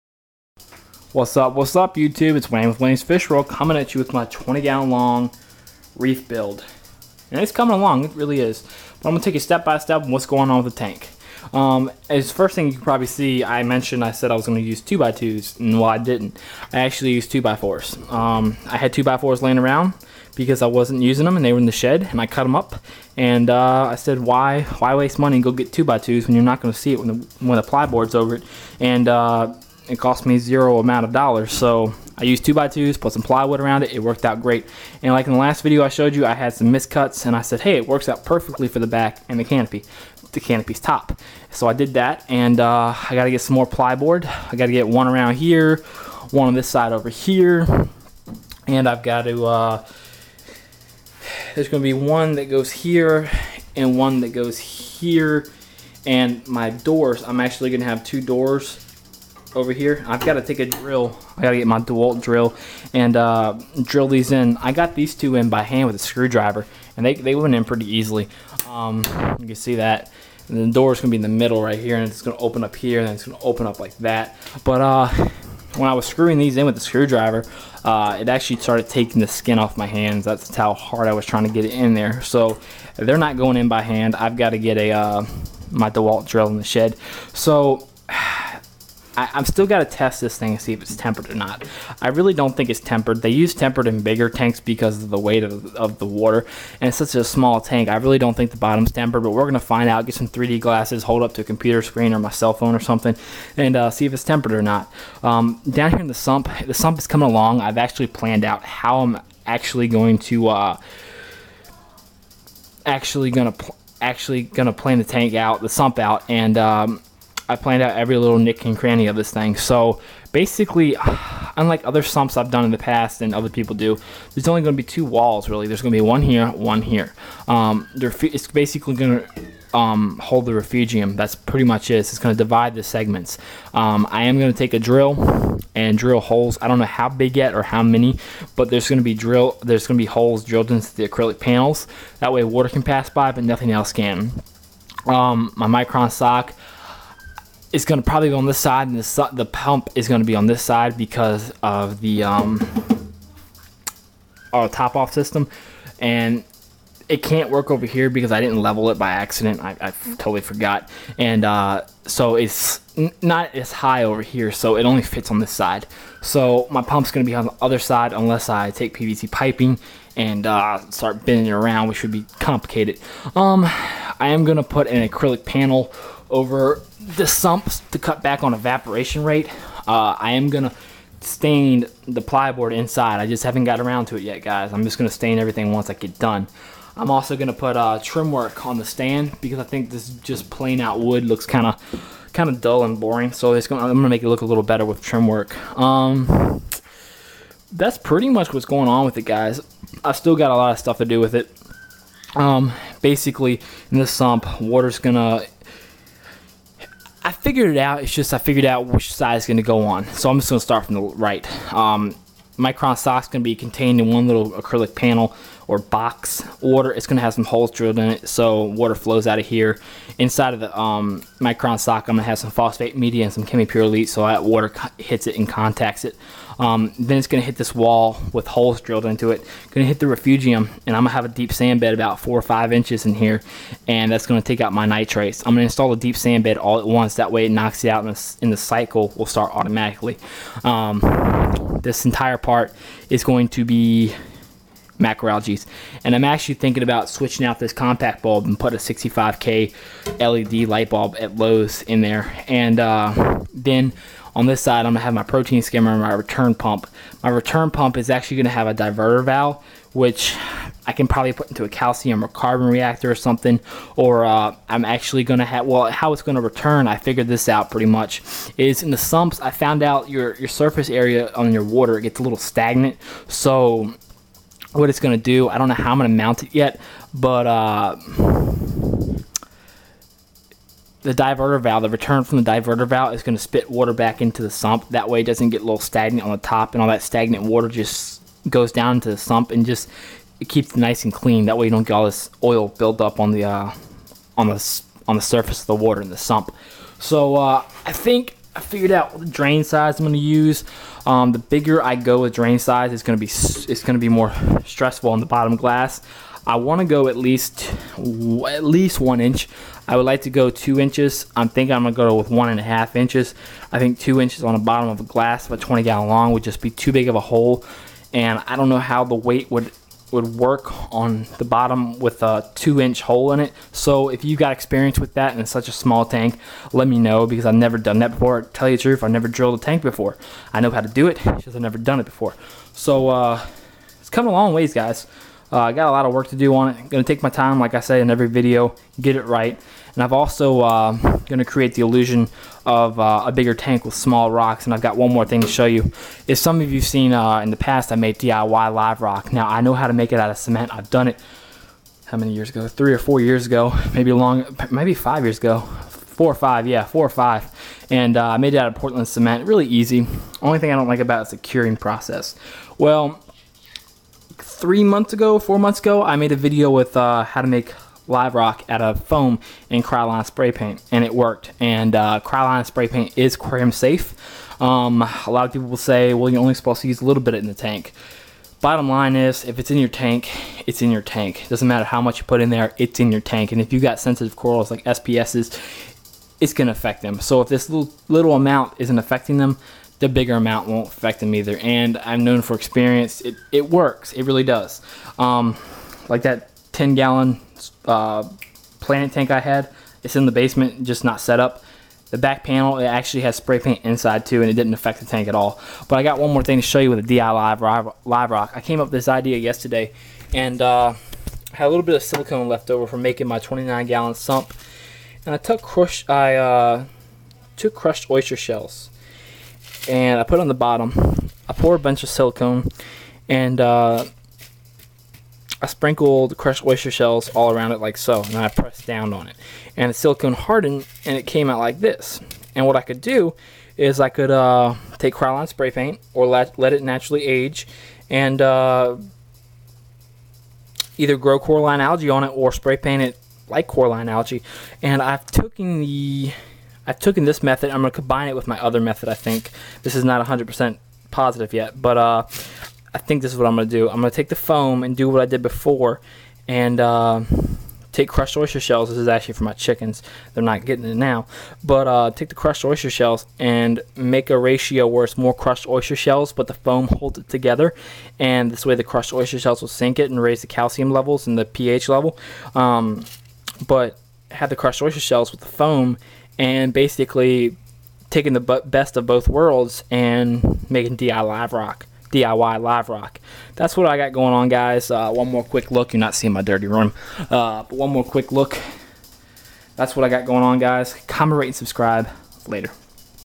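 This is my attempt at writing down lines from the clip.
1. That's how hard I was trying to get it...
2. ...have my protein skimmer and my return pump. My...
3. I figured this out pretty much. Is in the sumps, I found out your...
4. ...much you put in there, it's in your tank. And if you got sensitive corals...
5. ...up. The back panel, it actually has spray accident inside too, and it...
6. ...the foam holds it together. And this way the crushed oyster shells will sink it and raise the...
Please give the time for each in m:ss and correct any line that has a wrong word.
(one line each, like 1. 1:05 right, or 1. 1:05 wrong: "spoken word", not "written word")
1. 1:20 right
2. 4:15 right
3. 4:26 right
4. 6:21 right
5. 6:41 wrong: "paint", not "accident"
6. 7:46 right.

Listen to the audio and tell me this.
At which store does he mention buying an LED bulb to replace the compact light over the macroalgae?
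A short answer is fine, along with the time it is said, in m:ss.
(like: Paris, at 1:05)
Lowe's, at 4:11.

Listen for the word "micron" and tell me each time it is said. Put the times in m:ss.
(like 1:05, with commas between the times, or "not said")
2:25, 3:32, 3:41.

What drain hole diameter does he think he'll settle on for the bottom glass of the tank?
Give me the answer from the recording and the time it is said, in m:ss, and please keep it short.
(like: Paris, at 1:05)
1.5 inches, at 5:12.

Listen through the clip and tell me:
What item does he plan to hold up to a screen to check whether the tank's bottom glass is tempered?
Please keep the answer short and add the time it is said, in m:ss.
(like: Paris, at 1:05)
3D glasses, at 1:40.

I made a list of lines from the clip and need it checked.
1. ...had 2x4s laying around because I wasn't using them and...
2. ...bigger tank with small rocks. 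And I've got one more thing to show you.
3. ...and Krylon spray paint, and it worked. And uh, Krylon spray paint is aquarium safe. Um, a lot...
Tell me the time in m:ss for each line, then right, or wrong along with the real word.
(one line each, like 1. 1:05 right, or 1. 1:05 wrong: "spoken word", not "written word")
1. 0:18 right
2. 5:43 right
3. 6:09 right.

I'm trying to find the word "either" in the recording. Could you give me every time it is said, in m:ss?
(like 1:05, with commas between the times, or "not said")
6:31, 7:20.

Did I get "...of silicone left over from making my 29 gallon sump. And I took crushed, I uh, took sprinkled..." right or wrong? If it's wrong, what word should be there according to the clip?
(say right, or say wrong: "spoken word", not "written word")
wrong: "crushed", not "sprinkled".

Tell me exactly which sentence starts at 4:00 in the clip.
Um, this entire part is going to be macroalgae.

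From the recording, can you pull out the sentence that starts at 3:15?
Um, that's pretty much what's going on with it, guys.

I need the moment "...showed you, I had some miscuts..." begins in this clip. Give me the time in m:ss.
0:35.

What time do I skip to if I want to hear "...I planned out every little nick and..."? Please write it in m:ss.
1:57.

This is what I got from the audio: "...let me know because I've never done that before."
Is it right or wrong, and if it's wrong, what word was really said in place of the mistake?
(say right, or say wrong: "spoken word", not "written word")
right.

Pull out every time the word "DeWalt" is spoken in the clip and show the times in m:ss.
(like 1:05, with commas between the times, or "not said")
1:01, 1:25.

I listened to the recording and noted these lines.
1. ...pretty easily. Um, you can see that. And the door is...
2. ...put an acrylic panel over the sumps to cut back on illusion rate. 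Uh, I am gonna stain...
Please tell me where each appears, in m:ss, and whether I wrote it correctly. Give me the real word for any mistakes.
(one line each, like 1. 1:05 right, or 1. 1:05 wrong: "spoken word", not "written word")
1. 1:07 right
2. 2:54 wrong: "evaporation", not "illusion".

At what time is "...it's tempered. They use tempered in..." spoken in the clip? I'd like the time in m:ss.
1:32.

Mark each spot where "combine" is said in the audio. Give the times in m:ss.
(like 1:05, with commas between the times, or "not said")
7:27.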